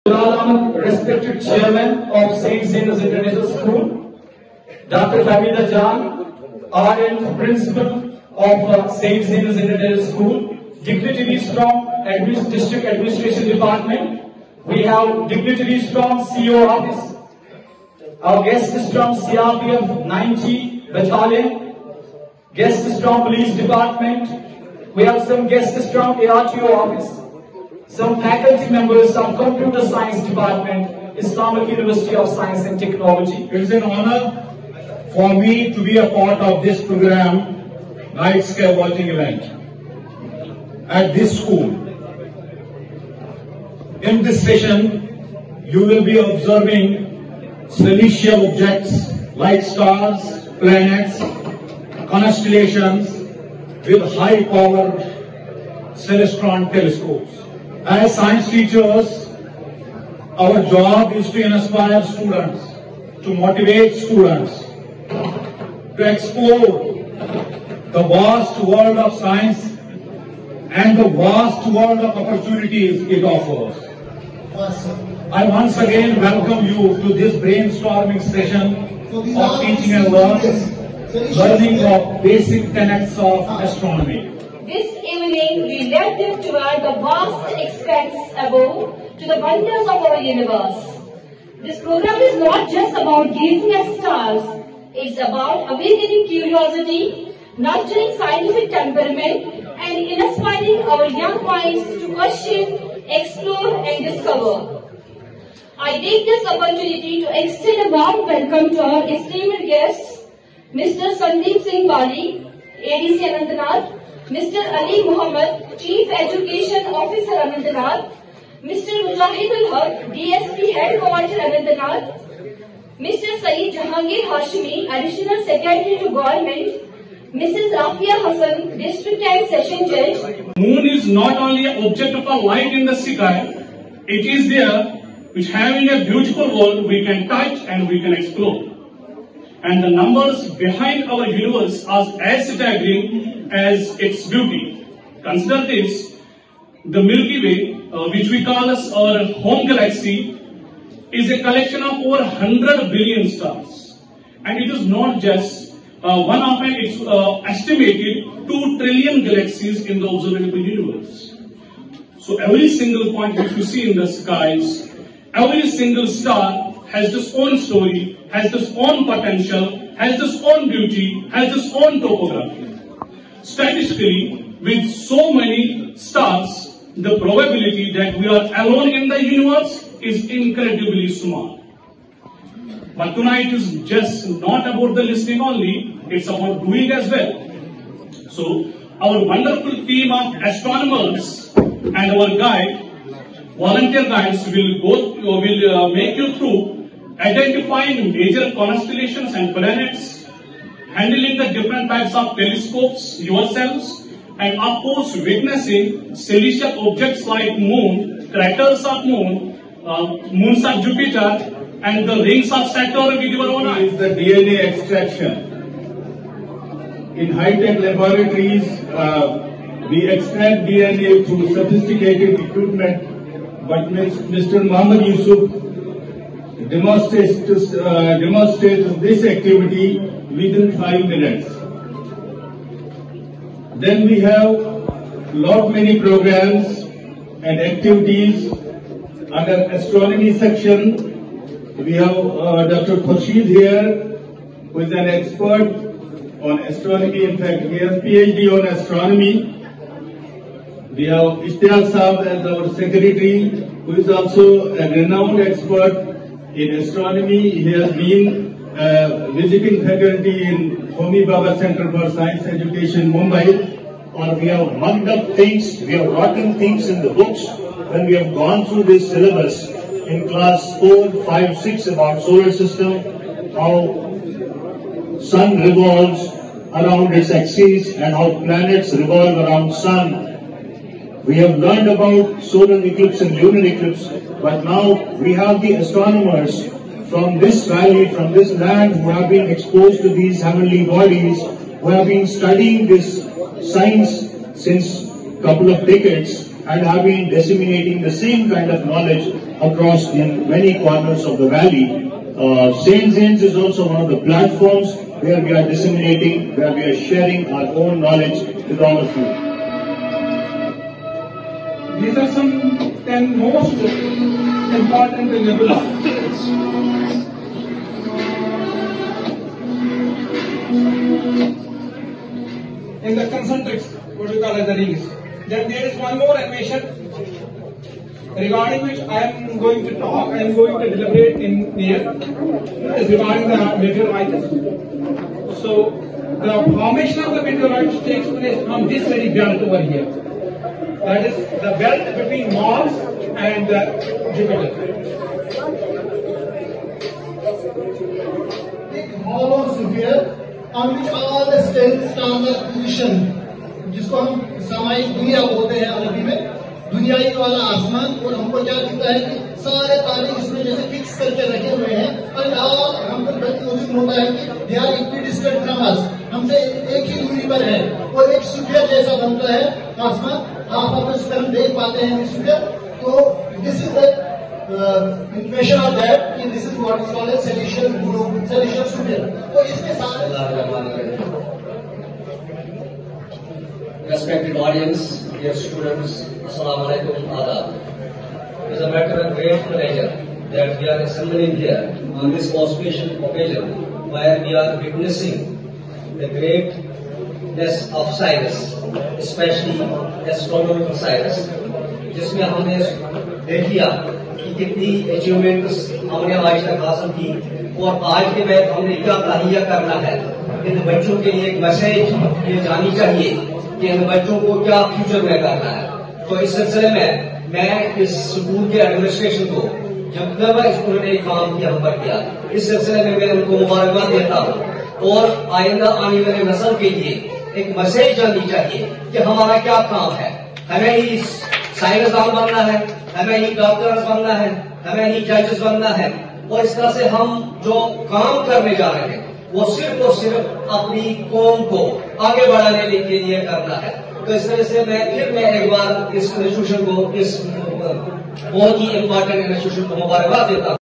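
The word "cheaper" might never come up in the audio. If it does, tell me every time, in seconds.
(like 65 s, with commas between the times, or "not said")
not said.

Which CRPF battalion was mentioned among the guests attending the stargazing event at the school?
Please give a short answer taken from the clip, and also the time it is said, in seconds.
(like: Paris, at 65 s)
90 Battalion, at 19 s.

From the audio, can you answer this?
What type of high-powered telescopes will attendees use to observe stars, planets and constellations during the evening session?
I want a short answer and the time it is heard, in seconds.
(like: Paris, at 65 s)
Celestron, at 55 s.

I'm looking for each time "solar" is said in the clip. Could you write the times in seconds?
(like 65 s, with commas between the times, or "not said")
272 s, 282 s.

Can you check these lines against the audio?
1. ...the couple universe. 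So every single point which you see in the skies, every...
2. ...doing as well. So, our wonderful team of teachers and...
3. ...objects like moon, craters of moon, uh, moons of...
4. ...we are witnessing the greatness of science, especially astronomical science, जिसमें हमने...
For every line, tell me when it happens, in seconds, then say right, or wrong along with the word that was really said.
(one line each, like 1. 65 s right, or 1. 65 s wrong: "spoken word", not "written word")
1. 159 s wrong: "observable", not "couple"
2. 186 s wrong: "astronomers", not "teachers"
3. 206 s right
4. 394 s right.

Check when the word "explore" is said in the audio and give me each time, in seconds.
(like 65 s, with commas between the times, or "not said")
66 s, 103 s, 138 s.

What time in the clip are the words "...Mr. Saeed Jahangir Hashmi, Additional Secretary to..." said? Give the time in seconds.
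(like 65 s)
122 s.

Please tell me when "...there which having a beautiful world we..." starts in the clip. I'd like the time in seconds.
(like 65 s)
134 s.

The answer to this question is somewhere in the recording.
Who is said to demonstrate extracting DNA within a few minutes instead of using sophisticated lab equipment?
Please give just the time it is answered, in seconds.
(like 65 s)
223 s.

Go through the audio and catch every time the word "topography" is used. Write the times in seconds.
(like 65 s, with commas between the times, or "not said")
171 s.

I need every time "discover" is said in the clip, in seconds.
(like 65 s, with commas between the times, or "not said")
104 s.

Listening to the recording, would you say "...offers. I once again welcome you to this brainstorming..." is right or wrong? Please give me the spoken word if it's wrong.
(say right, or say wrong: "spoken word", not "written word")
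right.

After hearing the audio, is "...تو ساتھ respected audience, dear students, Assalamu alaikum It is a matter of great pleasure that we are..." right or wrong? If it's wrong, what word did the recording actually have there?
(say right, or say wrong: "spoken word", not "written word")
right.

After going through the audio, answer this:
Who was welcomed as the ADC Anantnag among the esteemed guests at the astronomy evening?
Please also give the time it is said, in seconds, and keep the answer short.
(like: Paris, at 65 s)
Sandeep Singh Bali, at 110 s.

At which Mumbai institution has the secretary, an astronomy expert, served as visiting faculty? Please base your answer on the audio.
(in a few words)
Homi Bhabha Center for Science Education.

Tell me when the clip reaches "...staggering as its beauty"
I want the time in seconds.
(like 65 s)
142 s.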